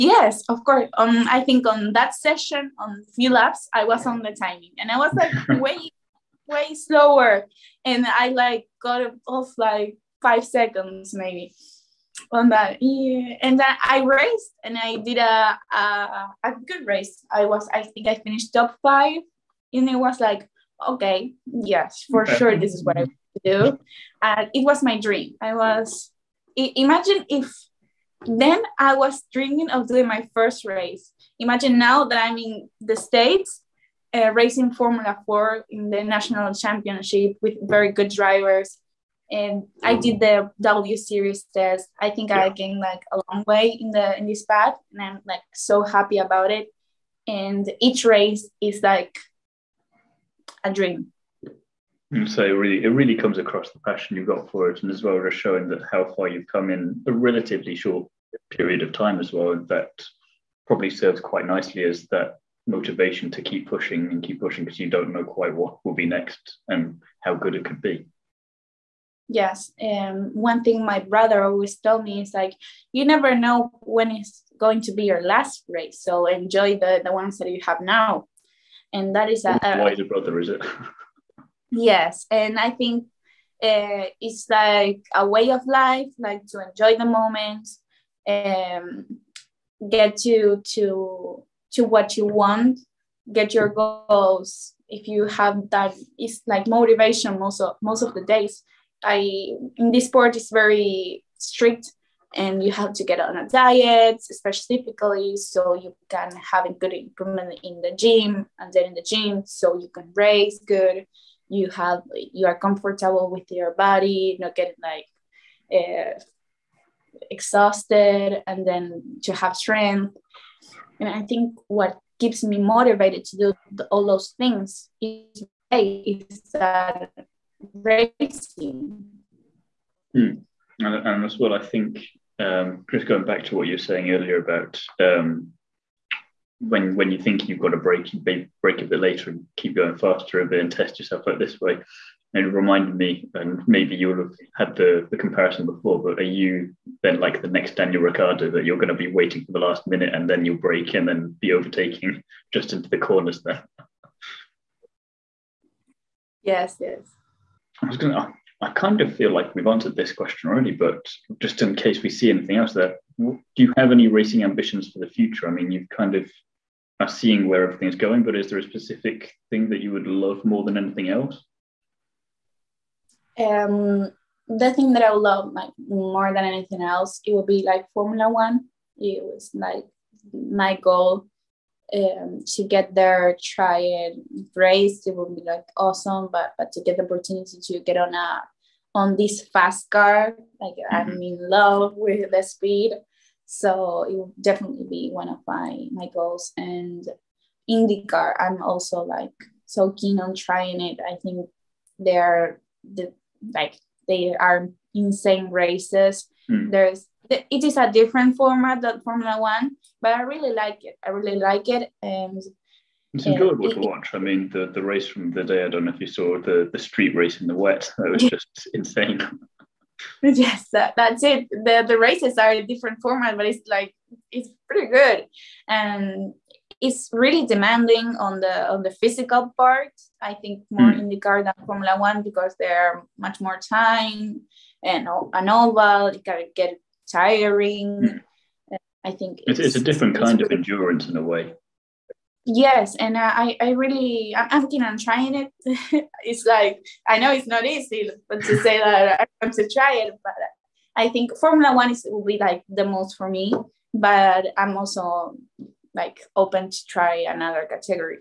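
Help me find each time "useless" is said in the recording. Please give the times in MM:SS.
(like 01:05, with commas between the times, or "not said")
not said.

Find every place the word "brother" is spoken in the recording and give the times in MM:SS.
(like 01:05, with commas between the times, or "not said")
01:11, 01:20.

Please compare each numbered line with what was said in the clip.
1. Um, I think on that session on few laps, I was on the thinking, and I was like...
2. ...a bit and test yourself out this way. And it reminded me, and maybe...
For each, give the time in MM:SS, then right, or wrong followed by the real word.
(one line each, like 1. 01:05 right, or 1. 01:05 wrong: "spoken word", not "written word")
1. 00:00 wrong: "timing", not "thinking"
2. 02:20 right.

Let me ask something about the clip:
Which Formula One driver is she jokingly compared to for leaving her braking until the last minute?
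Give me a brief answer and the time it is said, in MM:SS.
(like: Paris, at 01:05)
Daniel Ricciardo, at 02:27.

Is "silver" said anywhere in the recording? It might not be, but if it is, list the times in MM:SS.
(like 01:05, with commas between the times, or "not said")
not said.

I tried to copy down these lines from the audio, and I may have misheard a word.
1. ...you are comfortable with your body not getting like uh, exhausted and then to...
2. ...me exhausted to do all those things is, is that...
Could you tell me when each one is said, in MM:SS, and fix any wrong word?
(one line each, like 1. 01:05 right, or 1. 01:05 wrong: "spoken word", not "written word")
1. 01:52 right
2. 02:02 wrong: "motivated", not "exhausted".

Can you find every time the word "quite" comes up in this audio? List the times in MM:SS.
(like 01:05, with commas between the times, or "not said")
01:01, 01:05.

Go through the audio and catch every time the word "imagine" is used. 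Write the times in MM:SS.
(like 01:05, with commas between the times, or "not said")
00:26, 00:31.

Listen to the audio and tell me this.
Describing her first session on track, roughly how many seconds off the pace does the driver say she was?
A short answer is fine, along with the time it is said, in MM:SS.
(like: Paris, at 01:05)
5, at 00:10.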